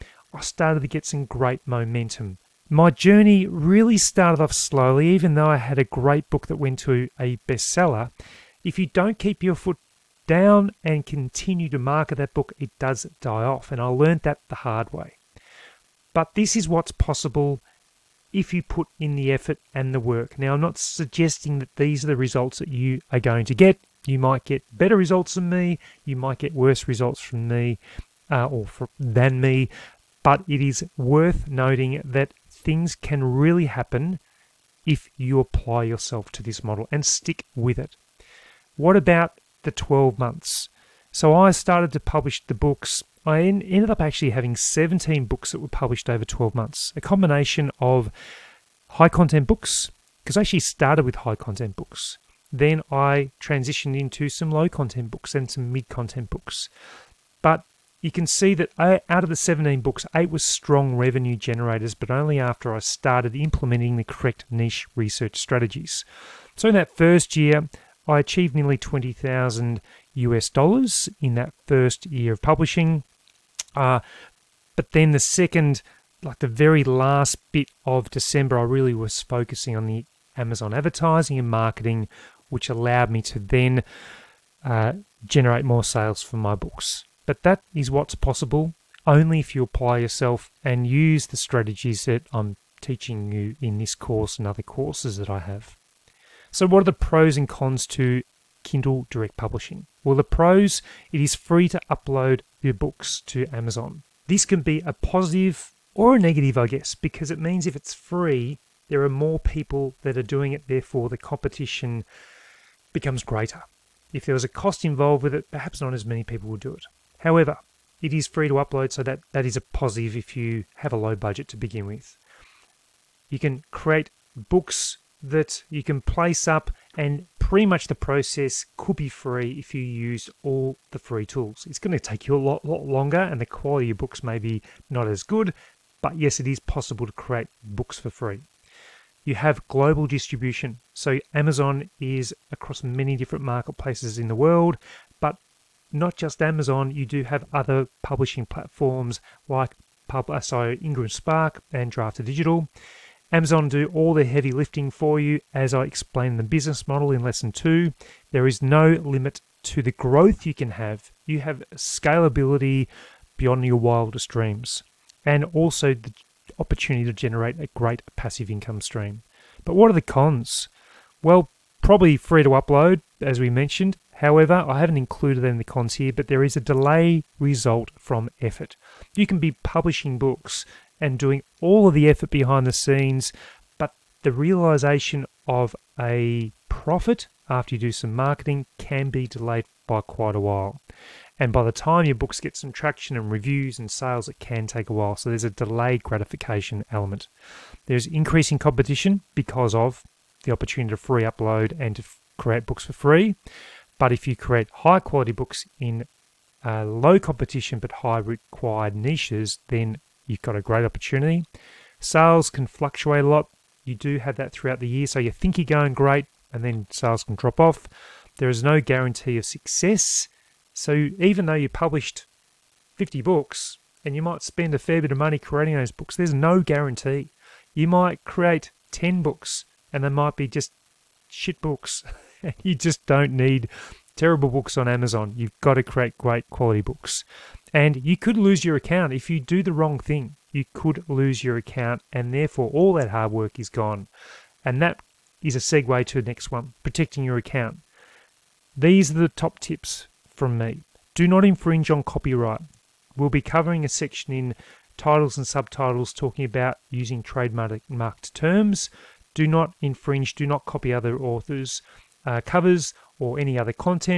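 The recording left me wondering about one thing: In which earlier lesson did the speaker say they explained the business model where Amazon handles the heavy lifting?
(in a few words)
Lesson two.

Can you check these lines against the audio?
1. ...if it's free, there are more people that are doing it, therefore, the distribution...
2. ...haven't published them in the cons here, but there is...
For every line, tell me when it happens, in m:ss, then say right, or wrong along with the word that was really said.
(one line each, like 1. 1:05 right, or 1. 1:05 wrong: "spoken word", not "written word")
1. 1:47 wrong: "competition", not "distribution"
2. 2:54 wrong: "included", not "published".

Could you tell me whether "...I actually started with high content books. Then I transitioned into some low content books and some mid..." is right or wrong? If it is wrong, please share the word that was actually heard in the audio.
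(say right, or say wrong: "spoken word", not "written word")
right.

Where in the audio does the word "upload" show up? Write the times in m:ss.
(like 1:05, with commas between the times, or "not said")
1:41, 1:58, 2:52, 3:21.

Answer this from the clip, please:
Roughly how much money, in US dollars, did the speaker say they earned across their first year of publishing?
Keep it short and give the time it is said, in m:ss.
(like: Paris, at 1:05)
20,000 US dollars, at 1:08.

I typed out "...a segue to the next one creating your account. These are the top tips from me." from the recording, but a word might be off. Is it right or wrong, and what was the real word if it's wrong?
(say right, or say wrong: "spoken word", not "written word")
wrong: "protecting", not "creating".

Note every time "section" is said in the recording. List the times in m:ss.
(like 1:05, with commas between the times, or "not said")
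4:13.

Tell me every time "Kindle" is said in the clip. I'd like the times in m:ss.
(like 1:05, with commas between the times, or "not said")
1:38.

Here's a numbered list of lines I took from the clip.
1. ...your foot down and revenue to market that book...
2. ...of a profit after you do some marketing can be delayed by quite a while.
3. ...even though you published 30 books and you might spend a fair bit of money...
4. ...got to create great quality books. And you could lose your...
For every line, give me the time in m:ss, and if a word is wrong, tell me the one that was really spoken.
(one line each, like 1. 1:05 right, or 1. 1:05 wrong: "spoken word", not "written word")
1. 0:09 wrong: "continue", not "revenue"
2. 3:05 right
3. 3:41 wrong: "50", not "30"
4. 3:55 right.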